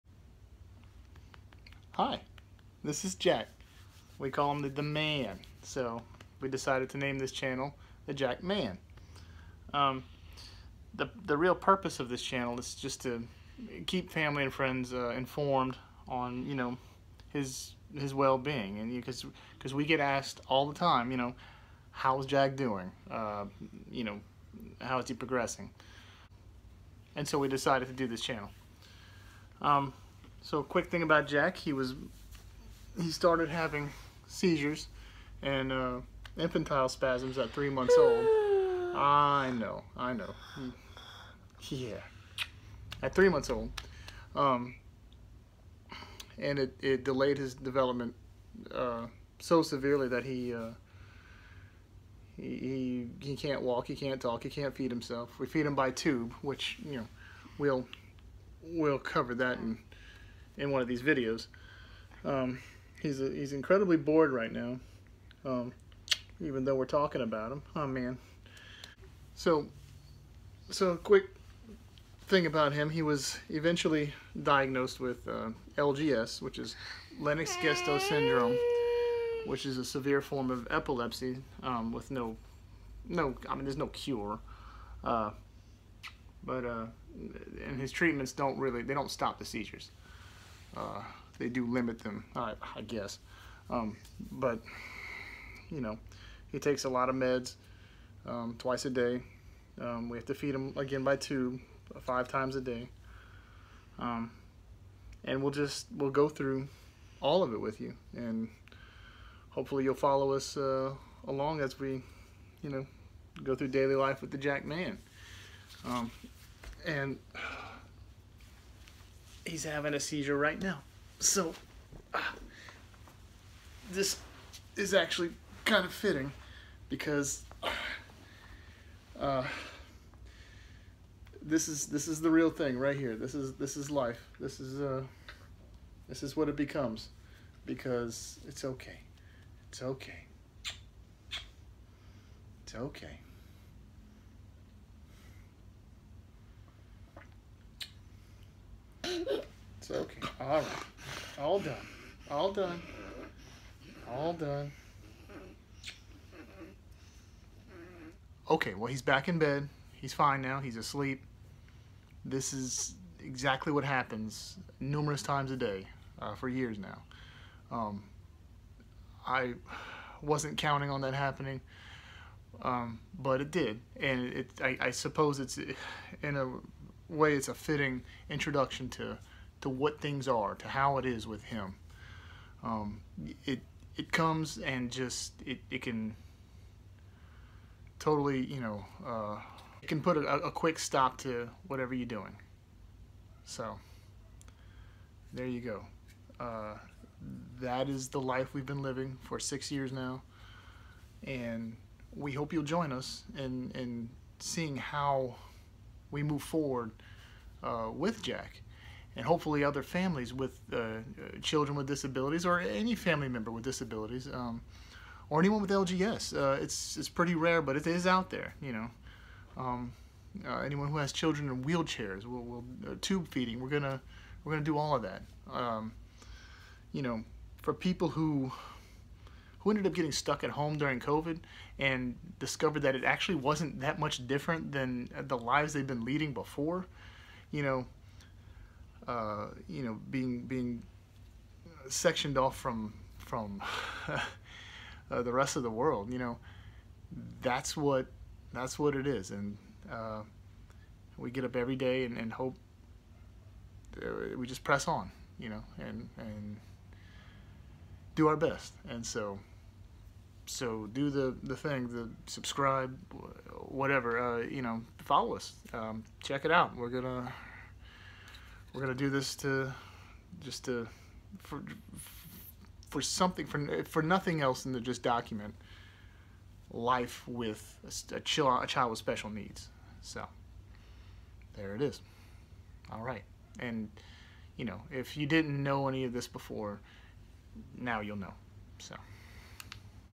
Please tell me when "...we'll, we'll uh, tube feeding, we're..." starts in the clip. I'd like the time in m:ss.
3:42.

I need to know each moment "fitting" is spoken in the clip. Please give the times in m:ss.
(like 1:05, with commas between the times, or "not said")
2:05, 2:57.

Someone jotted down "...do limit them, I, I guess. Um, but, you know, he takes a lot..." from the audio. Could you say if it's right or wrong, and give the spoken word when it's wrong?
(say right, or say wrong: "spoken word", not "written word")
right.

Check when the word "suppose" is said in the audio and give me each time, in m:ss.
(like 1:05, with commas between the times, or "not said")
2:54.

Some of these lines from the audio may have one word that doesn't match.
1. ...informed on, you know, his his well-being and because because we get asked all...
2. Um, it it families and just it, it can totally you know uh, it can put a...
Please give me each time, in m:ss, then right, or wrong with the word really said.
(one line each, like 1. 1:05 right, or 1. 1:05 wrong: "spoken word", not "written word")
1. 0:15 right
2. 3:02 wrong: "comes", not "families".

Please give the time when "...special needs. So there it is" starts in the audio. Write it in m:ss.
4:38.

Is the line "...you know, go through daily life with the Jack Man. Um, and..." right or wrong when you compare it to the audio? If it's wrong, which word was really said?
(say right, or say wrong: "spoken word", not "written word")
right.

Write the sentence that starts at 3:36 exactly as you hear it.
Uh, it's, it's pretty rare, but it is out there, you know.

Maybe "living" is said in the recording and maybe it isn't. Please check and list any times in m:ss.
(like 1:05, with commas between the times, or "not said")
3:18.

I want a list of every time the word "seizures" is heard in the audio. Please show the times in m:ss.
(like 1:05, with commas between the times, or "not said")
0:34, 1:29, 1:59.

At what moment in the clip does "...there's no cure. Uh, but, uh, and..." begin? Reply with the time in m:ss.
1:23.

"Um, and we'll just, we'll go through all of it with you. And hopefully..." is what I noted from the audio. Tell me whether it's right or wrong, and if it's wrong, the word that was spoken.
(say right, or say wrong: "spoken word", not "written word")
right.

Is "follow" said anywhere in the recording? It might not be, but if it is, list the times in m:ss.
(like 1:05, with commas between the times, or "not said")
1:49, 4:24.